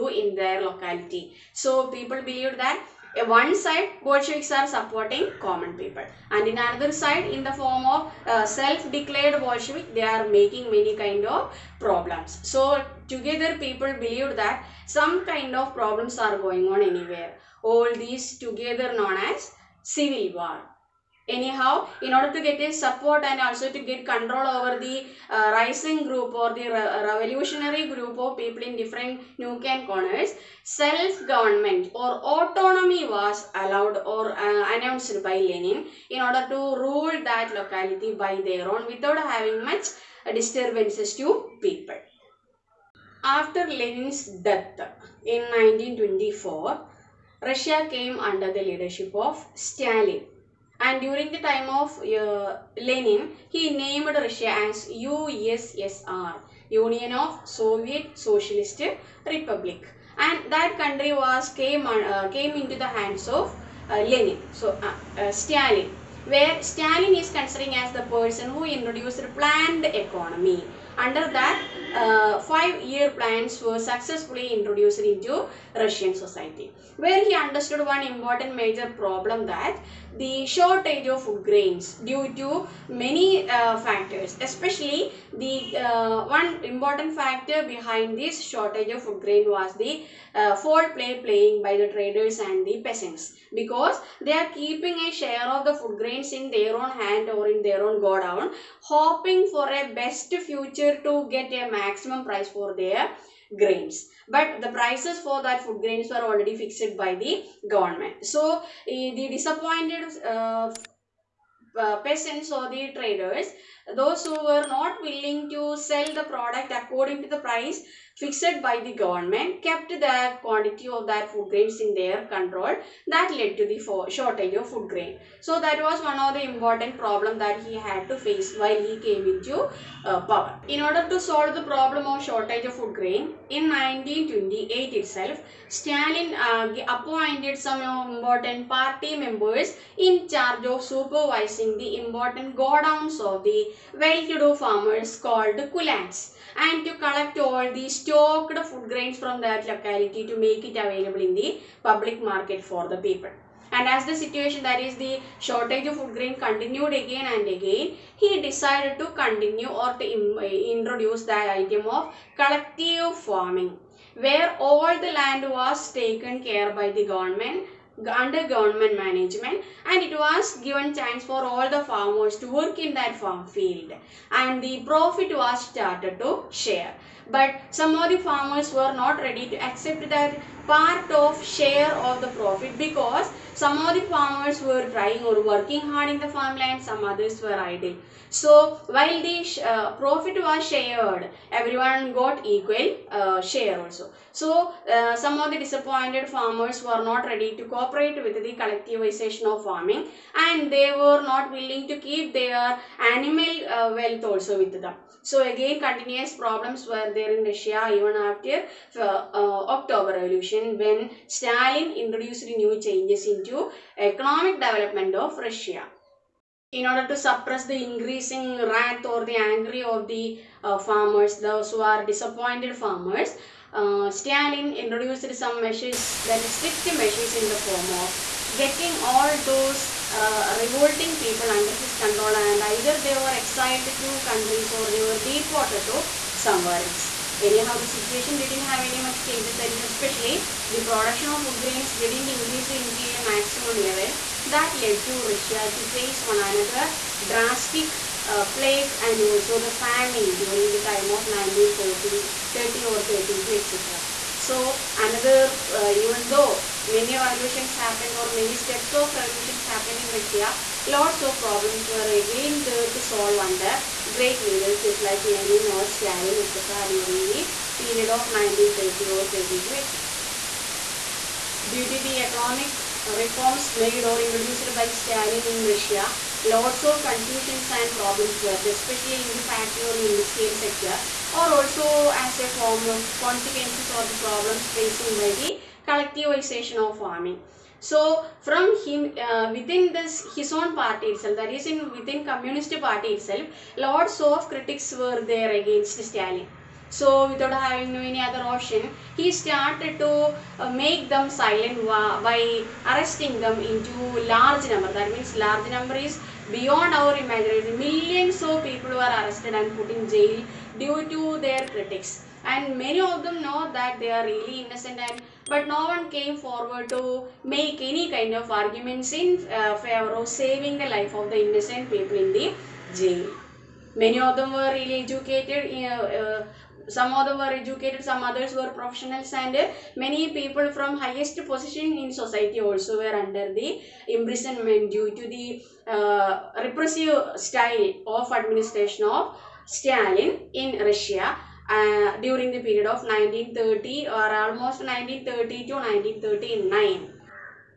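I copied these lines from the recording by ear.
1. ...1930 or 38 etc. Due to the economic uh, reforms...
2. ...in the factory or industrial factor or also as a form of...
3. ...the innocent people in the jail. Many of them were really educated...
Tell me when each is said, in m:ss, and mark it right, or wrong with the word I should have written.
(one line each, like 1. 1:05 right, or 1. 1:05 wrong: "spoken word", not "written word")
1. 4:28 wrong: "32", not "38"
2. 4:39 wrong: "sector", not "factor"
3. 5:21 right.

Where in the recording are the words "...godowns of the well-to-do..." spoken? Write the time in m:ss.
2:22.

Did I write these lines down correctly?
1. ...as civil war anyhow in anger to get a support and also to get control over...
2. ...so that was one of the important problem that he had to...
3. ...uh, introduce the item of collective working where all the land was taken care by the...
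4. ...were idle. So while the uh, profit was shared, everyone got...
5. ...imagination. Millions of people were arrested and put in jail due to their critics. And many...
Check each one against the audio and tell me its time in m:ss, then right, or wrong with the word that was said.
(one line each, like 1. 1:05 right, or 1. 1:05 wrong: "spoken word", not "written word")
1. 0:19 wrong: "order", not "anger"
2. 2:05 right
3. 2:40 wrong: "farming", not "working"
4. 3:07 right
5. 5:07 right.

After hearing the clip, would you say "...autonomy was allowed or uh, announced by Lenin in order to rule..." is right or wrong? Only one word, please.
right.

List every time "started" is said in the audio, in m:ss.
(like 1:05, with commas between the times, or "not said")
2:55, 4:59.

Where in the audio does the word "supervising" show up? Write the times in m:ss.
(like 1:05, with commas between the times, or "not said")
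2:20.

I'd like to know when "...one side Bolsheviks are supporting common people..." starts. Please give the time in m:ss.
0:03.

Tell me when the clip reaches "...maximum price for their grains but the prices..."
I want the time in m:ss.
1:41.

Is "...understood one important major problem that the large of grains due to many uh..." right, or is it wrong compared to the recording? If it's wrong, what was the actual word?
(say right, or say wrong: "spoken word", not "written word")
wrong: "shortage", not "large".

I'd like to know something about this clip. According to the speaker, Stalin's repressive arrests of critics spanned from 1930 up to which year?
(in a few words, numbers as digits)
1939.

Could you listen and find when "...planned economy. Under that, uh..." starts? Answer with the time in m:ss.
1:09.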